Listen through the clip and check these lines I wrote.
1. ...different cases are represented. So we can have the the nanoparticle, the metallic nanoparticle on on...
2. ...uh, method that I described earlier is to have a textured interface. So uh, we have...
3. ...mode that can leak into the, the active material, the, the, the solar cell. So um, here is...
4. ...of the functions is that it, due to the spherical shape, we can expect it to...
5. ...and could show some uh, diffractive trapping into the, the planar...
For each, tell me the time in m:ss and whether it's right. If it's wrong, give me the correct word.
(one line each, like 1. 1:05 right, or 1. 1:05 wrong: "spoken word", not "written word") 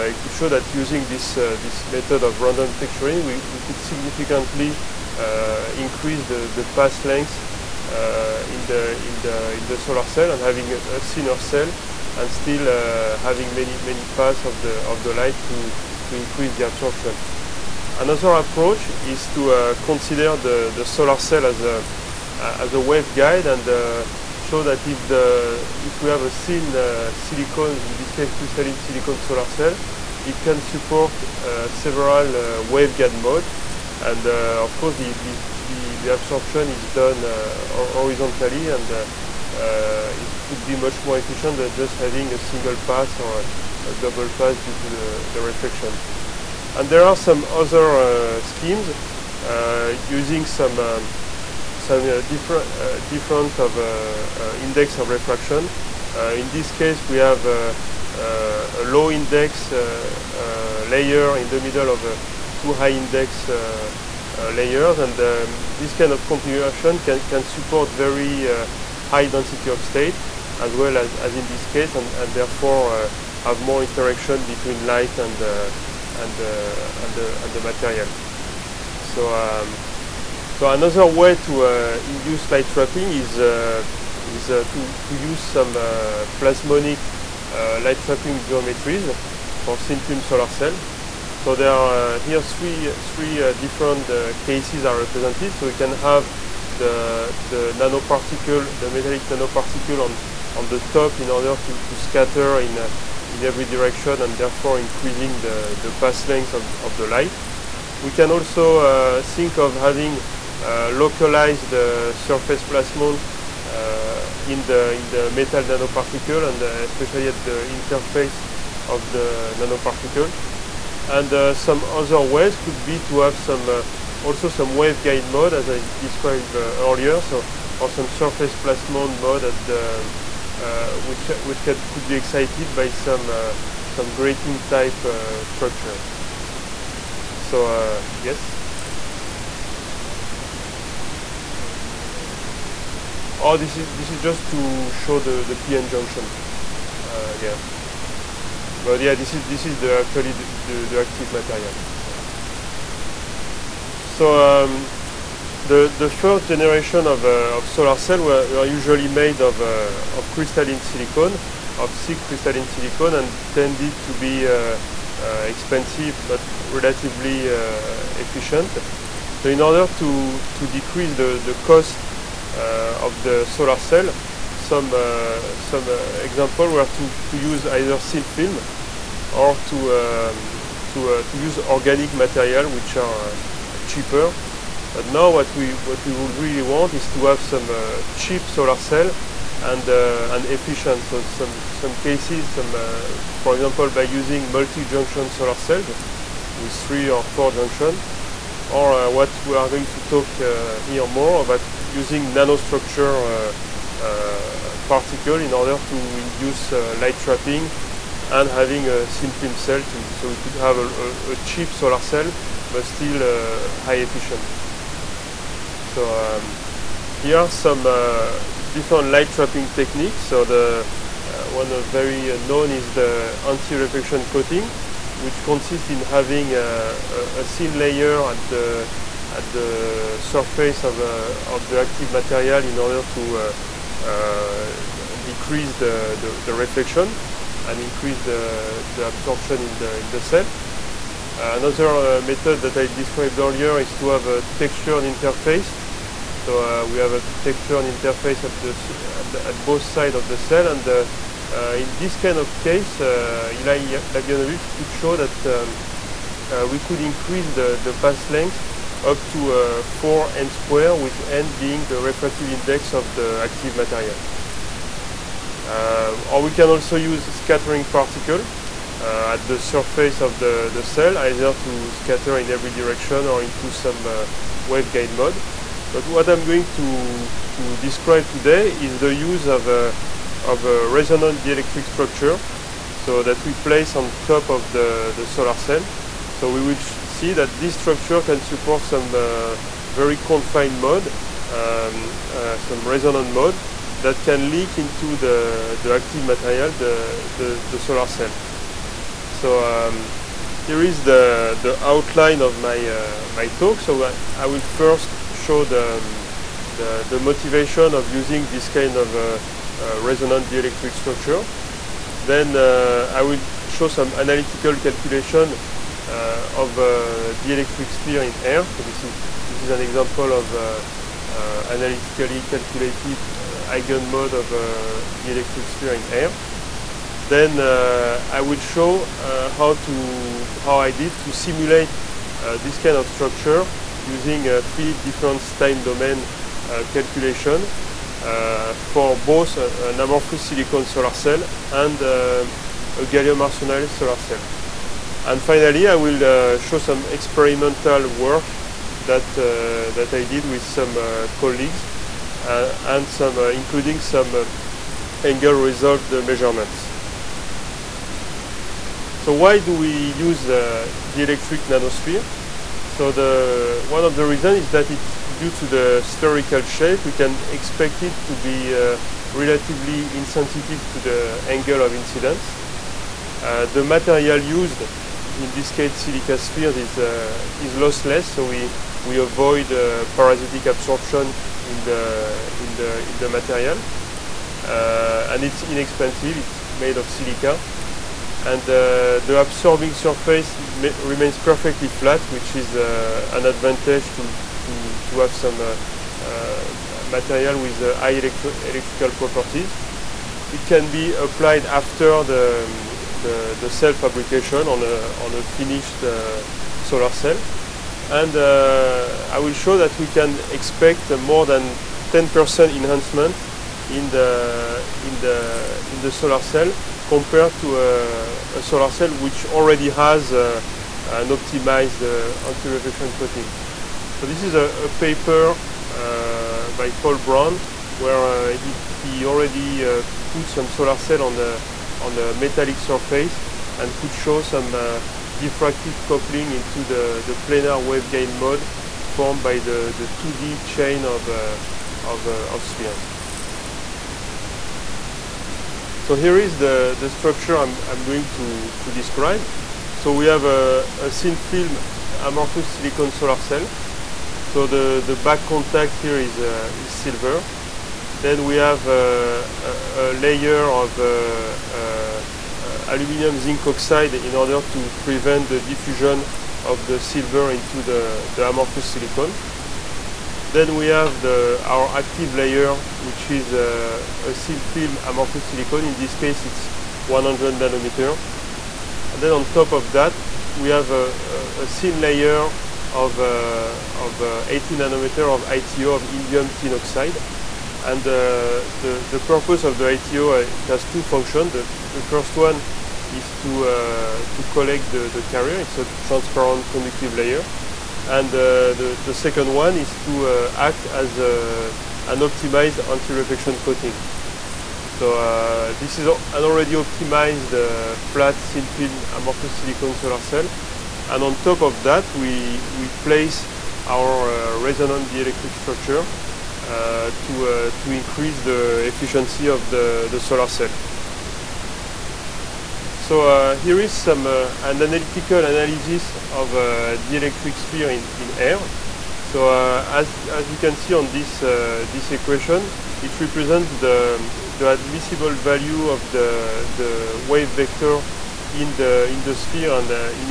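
1. 1:33 right
2. 4:02 right
3. 4:53 right
4. 6:04 wrong: "reasons", not "functions"
5. 7:13 wrong: "coupling", not "trapping".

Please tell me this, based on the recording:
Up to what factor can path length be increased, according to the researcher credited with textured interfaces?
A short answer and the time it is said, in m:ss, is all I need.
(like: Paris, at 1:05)
4 n squared, at 4:19.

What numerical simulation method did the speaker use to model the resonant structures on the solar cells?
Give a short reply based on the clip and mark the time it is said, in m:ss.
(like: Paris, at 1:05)
finite difference time domain, at 5:34.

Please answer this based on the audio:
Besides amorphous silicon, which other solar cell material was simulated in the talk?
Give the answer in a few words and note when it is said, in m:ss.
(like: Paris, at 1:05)
gallium arsenide, at 5:43.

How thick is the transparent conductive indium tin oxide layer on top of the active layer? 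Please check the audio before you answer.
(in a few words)
80 nanometers.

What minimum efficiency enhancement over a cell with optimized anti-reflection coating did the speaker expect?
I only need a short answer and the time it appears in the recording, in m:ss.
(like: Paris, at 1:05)
10%, at 6:52.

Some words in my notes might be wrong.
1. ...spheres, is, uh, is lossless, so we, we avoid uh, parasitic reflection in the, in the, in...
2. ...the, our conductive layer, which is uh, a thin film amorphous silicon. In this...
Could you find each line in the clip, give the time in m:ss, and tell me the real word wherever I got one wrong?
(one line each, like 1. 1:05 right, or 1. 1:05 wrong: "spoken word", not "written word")
1. 6:16 wrong: "absorption", not "reflection"
2. 7:51 wrong: "active", not "conductive".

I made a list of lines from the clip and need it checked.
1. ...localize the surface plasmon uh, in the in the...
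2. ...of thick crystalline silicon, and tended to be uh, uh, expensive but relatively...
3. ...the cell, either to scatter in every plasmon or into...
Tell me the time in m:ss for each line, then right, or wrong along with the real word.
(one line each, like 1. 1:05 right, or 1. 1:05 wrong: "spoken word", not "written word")
1. 1:50 right
2. 2:41 right
3. 4:30 wrong: "direction", not "plasmon".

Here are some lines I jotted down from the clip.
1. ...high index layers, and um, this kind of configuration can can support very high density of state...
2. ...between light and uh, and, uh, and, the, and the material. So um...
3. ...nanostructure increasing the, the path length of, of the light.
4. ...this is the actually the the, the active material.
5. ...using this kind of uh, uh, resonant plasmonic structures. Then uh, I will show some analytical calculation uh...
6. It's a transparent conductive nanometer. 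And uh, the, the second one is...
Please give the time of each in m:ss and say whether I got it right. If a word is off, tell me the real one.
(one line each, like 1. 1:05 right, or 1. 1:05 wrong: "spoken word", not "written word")
1. 1:02 right
2. 1:14 right
3. 1:44 wrong: "therefore", not "nanostructure"
4. 2:29 right
5. 5:08 wrong: "dielectric", not "plasmonic"
6. 8:15 wrong: "layer", not "nanometer".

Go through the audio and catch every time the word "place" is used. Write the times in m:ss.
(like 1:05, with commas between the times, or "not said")
4:43, 8:32.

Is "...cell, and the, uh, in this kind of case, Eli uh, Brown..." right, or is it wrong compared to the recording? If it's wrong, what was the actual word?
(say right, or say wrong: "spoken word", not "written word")
wrong: "Yablonovitch", not "Brown".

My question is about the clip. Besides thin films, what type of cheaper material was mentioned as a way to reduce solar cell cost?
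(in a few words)
organic material.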